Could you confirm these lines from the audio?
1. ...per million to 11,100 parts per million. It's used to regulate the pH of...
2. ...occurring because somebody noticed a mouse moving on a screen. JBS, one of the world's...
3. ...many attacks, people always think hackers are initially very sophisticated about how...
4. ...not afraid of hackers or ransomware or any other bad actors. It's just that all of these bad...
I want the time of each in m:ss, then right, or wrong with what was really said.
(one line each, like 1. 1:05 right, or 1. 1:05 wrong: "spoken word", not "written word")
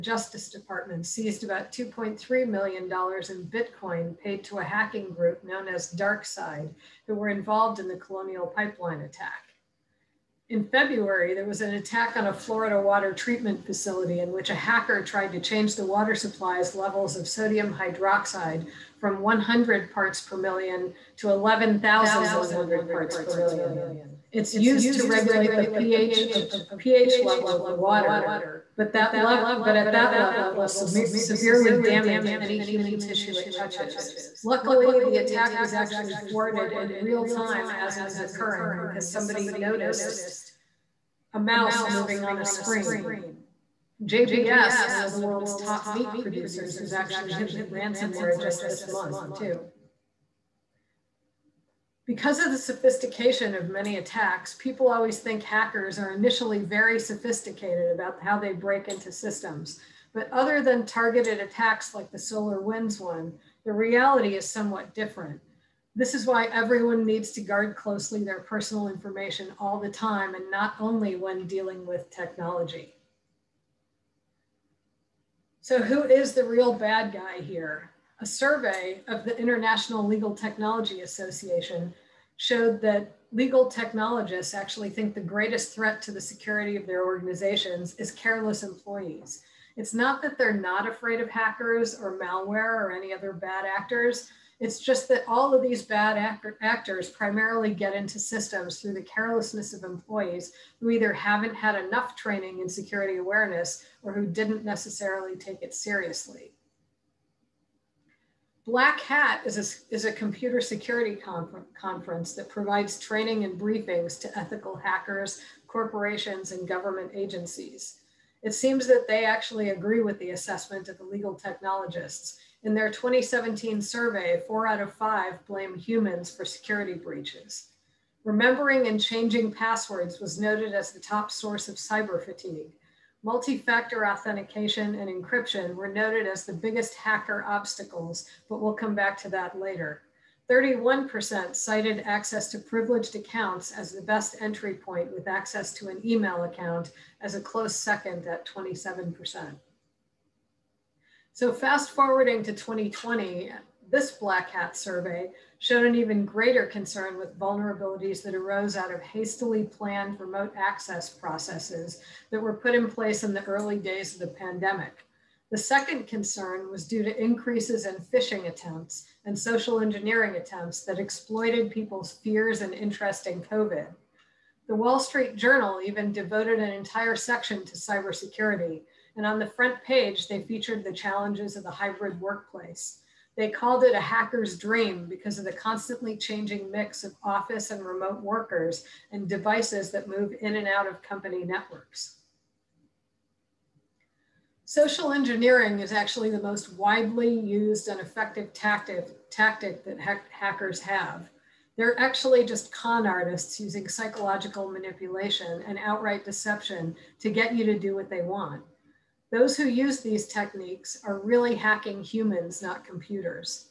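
1. 0:20 right
2. 0:38 right
3. 0:53 right
4. 1:30 wrong: "malware", not "ransomware".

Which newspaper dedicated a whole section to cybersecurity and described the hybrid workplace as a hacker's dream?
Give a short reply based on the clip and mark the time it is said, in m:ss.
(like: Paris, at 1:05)
The Wall Street Journal, at 2:54.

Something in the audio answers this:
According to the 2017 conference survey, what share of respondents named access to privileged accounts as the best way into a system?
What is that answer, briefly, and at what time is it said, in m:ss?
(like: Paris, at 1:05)
31%, at 2:20.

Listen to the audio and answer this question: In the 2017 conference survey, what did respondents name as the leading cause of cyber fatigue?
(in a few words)
Remembering and changing passwords.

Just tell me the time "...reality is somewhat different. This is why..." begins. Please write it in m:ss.
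1:03.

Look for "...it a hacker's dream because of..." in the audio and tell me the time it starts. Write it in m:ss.
3:03.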